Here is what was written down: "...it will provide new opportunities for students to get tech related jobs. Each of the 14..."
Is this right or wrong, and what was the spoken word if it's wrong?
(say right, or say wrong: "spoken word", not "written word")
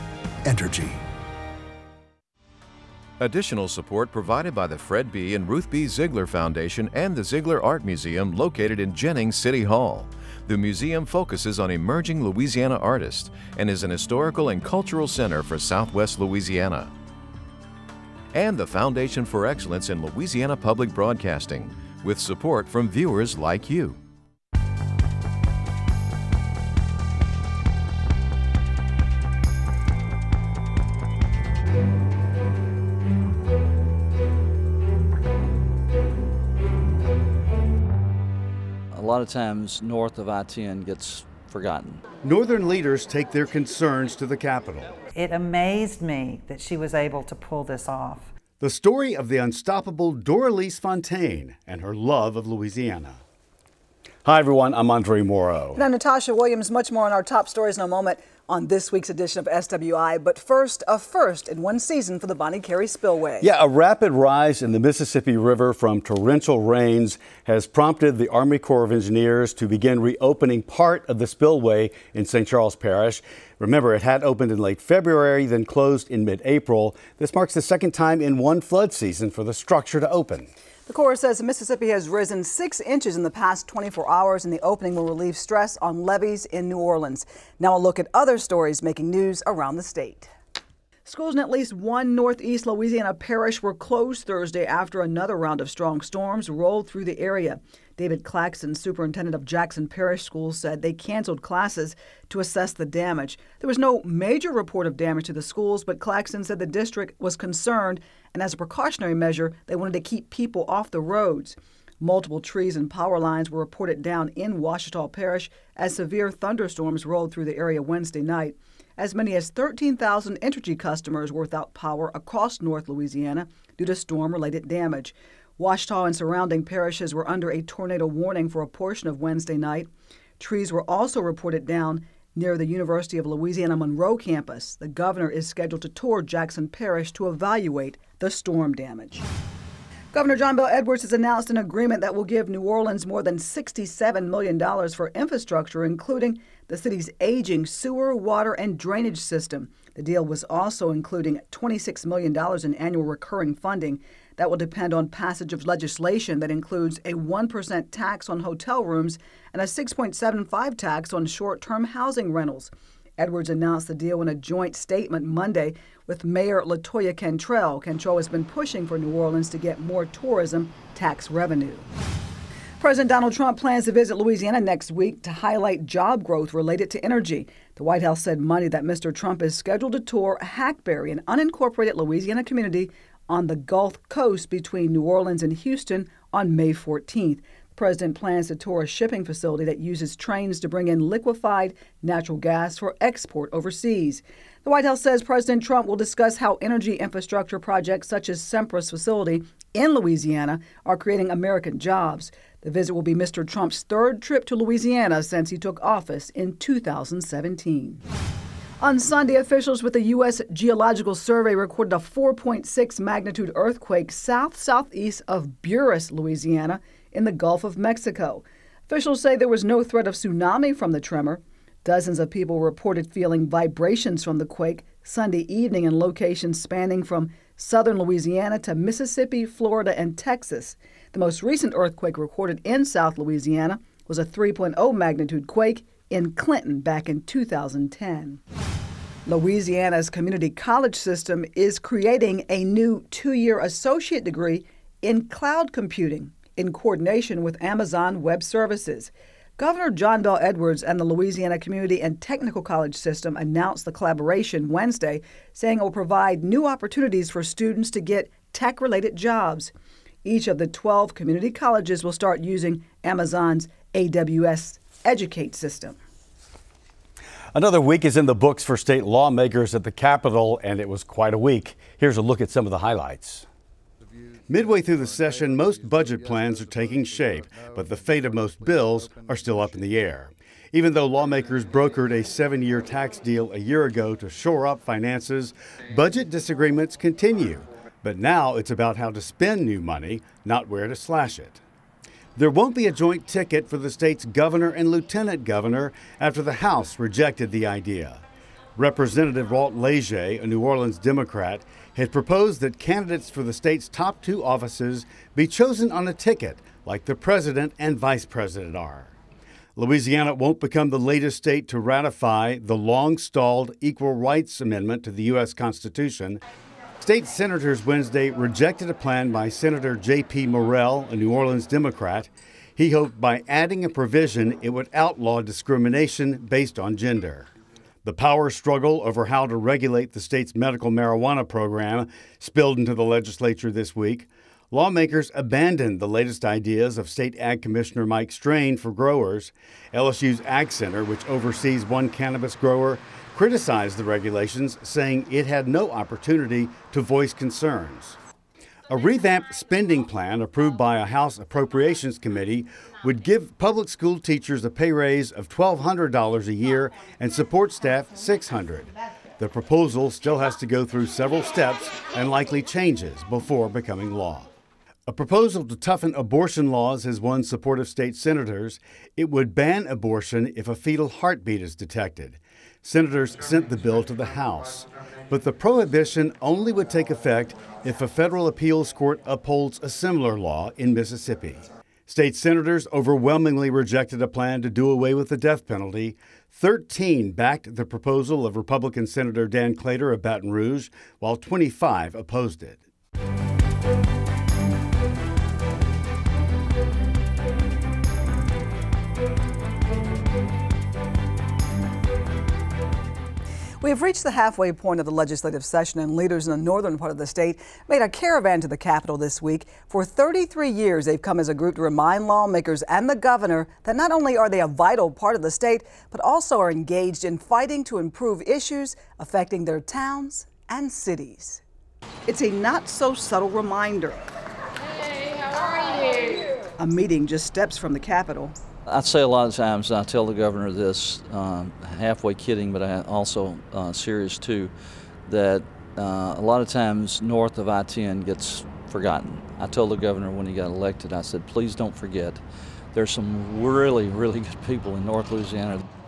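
wrong: "12", not "14".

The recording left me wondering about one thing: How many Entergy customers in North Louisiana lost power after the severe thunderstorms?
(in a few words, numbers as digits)
13,000.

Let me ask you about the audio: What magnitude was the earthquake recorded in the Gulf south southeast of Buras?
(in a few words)
4.6.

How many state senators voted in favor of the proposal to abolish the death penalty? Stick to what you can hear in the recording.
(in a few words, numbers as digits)
13.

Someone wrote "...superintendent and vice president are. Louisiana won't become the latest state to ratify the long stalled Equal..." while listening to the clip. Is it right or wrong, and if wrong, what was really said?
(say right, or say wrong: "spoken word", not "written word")
wrong: "president", not "superintendent".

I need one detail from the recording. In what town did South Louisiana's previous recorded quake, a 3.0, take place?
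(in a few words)
Clinton.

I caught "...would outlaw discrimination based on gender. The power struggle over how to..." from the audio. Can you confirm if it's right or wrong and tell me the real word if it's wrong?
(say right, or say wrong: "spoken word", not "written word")
right.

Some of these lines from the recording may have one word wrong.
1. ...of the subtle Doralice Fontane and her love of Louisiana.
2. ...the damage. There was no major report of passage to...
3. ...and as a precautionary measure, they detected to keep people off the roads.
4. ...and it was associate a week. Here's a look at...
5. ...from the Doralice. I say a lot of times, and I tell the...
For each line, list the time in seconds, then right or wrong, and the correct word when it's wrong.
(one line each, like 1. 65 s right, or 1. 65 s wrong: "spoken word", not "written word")
1. 49 s wrong: "unstoppable", not "subtle"
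2. 102 s wrong: "damage", not "passage"
3. 108 s wrong: "wanted", not "detected"
4. 270 s wrong: "quite", not "associate"
5. 427 s wrong: "Capitol", not "Doralice".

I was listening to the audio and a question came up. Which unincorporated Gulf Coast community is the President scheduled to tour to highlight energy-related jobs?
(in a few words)
Hackberry.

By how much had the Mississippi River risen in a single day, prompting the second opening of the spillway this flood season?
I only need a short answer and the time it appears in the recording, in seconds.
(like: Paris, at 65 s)
6 inches, at 82 s.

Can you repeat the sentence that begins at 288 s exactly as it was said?
But now it's about how to spend new money, not where to slash it.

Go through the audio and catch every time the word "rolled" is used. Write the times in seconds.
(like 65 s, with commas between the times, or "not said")
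96 s, 117 s.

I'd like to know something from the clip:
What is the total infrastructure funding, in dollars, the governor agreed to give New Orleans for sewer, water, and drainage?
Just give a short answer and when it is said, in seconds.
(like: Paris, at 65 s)
$67 million, at 143 s.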